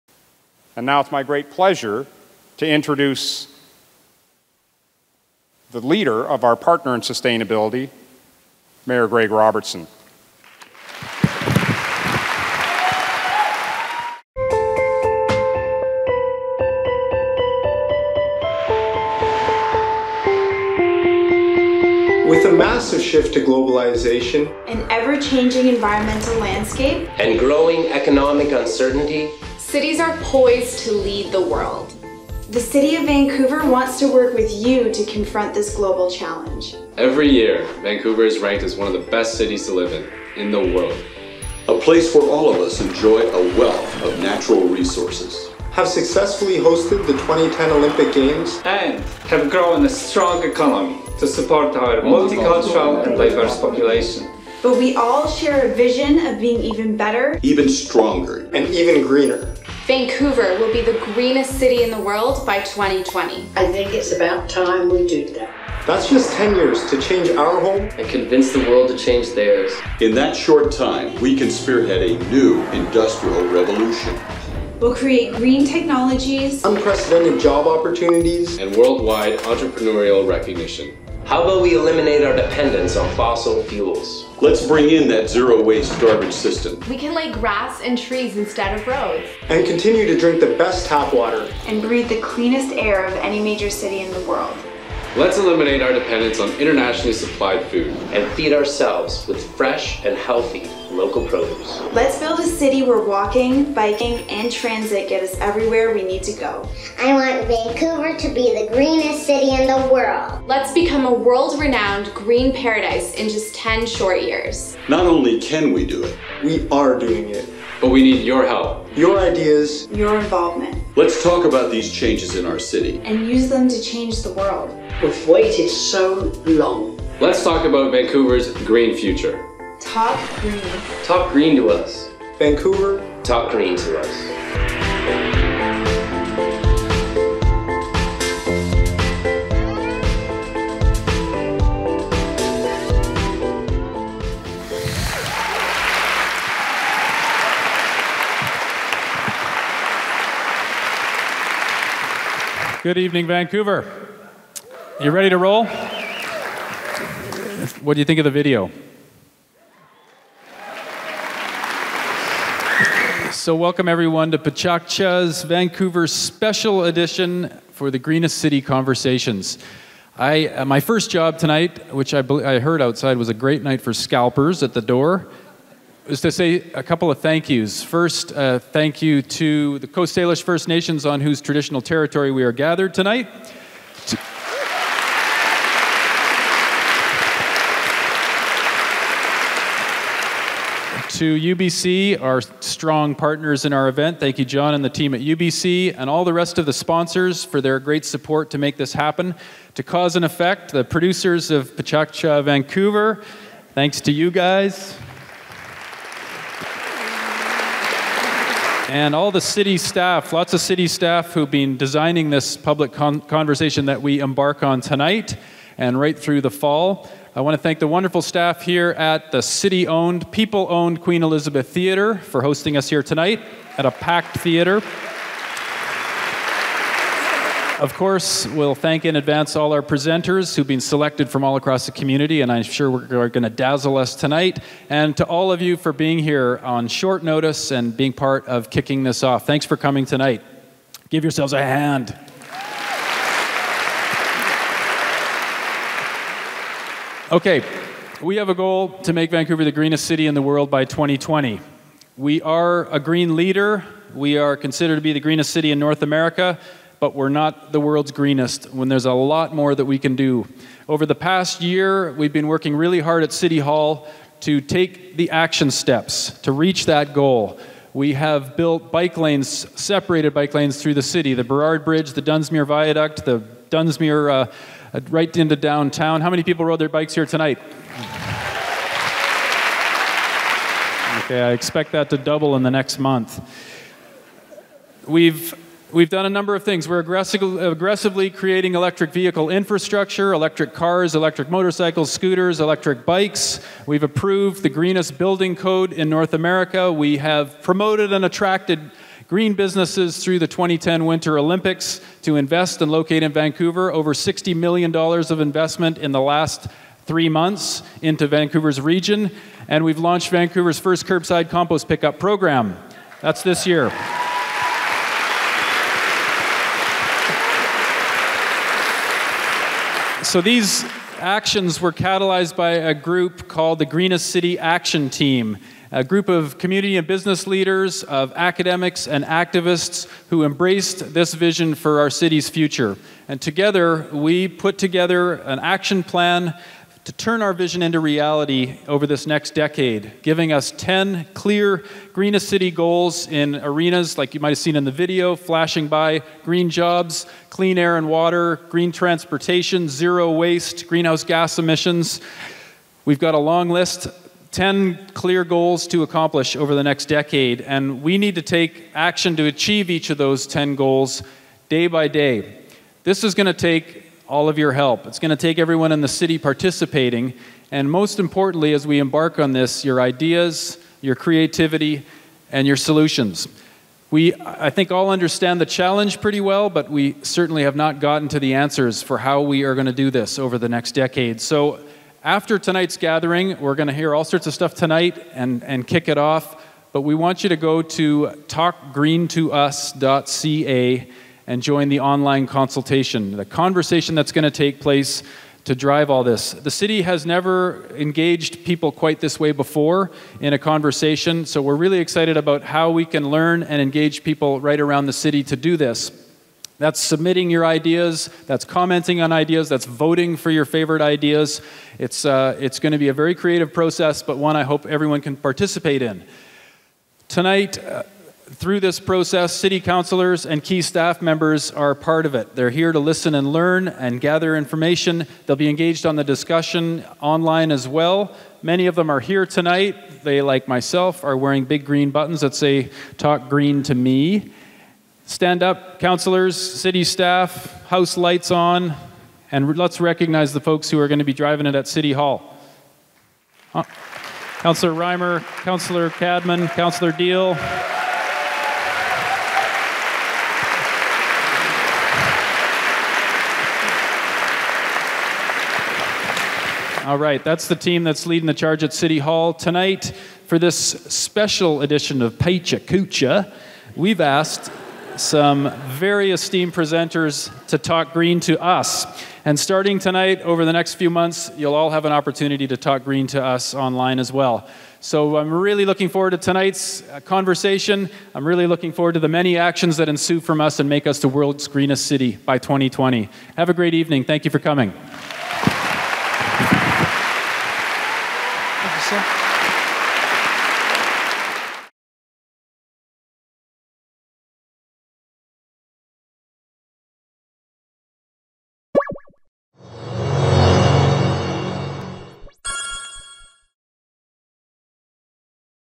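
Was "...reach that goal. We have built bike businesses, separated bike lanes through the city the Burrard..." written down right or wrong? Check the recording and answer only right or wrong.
wrong.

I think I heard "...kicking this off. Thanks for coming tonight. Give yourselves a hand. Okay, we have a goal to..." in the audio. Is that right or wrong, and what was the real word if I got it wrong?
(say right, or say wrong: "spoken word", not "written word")
right.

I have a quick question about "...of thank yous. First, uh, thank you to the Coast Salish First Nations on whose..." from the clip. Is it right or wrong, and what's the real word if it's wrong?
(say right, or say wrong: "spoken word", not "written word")
right.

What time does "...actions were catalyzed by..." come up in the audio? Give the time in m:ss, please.
5:21.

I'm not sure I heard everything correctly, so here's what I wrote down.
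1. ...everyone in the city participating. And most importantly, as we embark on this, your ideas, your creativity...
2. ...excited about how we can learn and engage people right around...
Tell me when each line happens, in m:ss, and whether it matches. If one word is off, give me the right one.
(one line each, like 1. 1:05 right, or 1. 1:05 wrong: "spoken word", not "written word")
1. 6:05 right
2. 6:41 right.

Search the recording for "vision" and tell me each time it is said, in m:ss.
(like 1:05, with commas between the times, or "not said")
0:55, 5:31, 5:37.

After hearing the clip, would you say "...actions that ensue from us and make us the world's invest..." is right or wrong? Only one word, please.
wrong.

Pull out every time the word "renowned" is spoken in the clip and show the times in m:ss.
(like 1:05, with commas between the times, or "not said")
1:51.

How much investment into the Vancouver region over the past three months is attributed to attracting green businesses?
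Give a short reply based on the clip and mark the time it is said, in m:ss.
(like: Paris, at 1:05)
Over $60 million, at 5:03.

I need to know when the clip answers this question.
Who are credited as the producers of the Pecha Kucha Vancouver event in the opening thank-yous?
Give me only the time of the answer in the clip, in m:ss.
3:19.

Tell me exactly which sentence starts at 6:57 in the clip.
Tonight, uh, through this process, city councilors and key staff members are part of it.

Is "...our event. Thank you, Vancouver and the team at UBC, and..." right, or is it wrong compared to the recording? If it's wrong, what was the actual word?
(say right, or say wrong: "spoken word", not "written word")
wrong: "John", not "Vancouver".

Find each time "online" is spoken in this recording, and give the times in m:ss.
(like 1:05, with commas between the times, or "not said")
6:31, 7:07, 7:53.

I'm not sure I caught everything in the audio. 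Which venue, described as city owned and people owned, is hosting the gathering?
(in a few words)
Queen Elizabeth Theatre.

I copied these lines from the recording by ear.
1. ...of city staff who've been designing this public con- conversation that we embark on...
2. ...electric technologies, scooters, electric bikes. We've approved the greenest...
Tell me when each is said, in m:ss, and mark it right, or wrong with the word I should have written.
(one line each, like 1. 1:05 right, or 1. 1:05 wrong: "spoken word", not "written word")
1. 3:30 right
2. 4:51 wrong: "motorcycles", not "technologies".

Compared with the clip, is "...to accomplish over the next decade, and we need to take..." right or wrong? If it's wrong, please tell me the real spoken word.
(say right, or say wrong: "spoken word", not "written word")
right.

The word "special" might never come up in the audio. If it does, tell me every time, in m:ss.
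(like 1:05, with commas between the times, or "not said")
2:46, 7:40.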